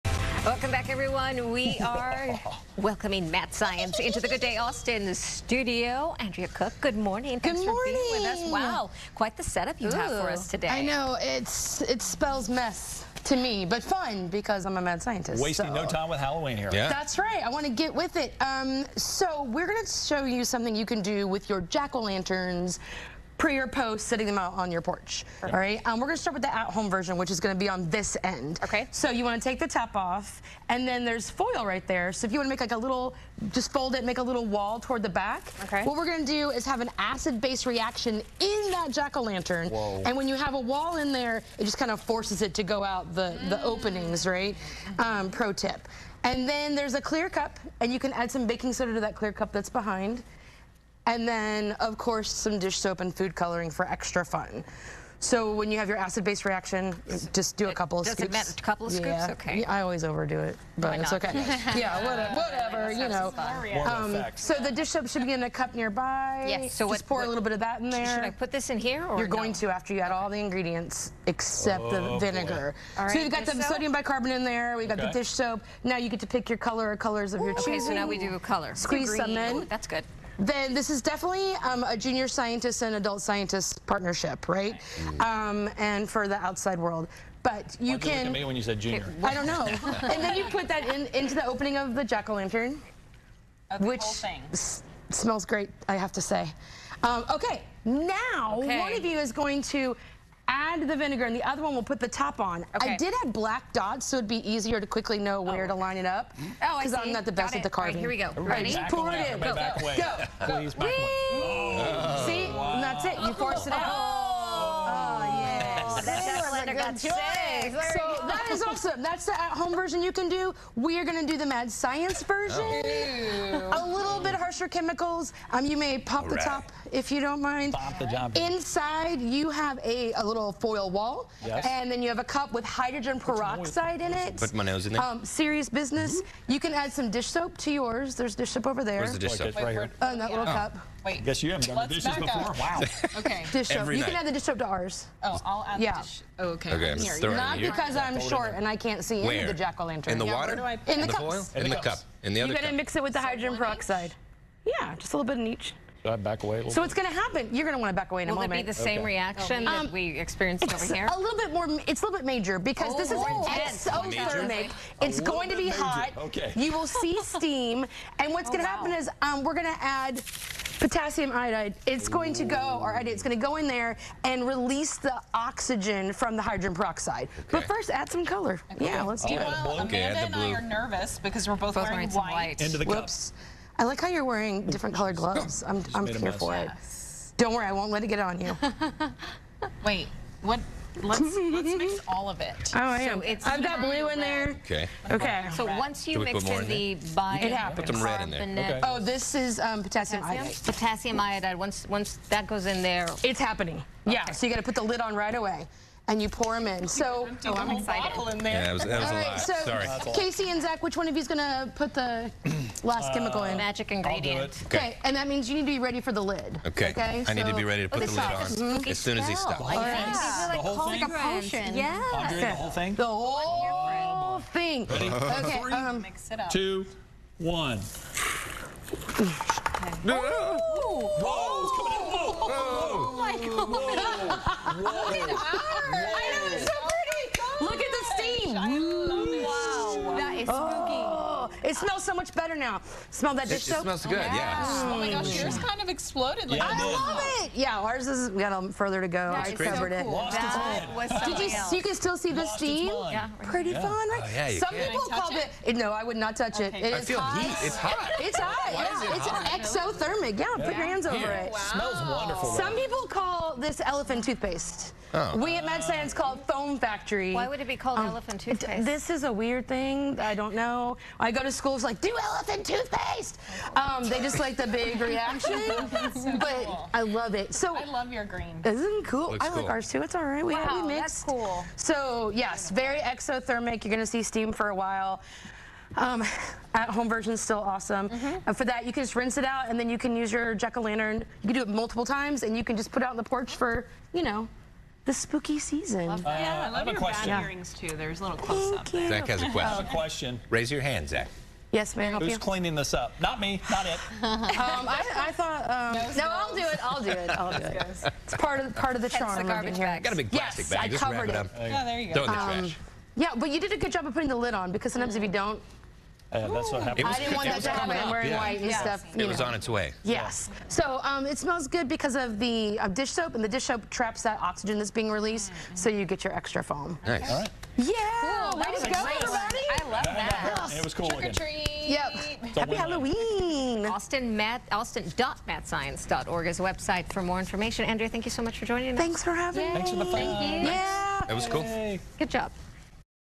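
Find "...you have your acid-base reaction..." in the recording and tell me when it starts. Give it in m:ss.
0:55.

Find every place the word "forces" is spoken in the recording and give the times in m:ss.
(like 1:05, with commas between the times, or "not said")
0:41, 1:53.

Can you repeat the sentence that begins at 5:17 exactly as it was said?
I didn't want that to happen.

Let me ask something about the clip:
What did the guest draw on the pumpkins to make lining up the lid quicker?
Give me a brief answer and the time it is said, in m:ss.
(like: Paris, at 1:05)
Black dots, at 1:43.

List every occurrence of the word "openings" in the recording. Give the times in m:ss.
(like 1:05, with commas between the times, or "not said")
0:43, 1:31.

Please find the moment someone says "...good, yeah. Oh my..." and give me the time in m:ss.
4:04.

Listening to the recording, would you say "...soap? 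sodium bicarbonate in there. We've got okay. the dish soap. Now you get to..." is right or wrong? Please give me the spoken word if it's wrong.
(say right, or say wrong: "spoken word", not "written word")
right.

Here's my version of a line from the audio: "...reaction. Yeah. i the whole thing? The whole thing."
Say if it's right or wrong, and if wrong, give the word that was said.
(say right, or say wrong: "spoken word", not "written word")
wrong: "potion", not "reaction".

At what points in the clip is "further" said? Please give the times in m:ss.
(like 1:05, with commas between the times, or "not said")
4:08.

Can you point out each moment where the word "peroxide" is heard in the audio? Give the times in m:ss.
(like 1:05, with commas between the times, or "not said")
2:13, 2:33, 2:56.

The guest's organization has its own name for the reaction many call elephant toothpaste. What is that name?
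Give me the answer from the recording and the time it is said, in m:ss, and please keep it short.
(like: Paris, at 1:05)
Foam Factory, at 4:26.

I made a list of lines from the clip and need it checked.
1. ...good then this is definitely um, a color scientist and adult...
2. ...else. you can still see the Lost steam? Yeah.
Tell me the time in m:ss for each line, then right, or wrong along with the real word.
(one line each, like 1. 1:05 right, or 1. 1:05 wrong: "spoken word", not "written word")
1. 1:19 wrong: "junior", not "color"
2. 4:11 right.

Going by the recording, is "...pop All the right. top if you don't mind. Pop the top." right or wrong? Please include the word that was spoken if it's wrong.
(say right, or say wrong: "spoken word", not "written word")
right.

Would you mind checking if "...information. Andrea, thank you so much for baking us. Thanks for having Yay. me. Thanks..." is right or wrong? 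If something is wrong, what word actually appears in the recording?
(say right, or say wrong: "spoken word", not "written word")
wrong: "joining", not "baking".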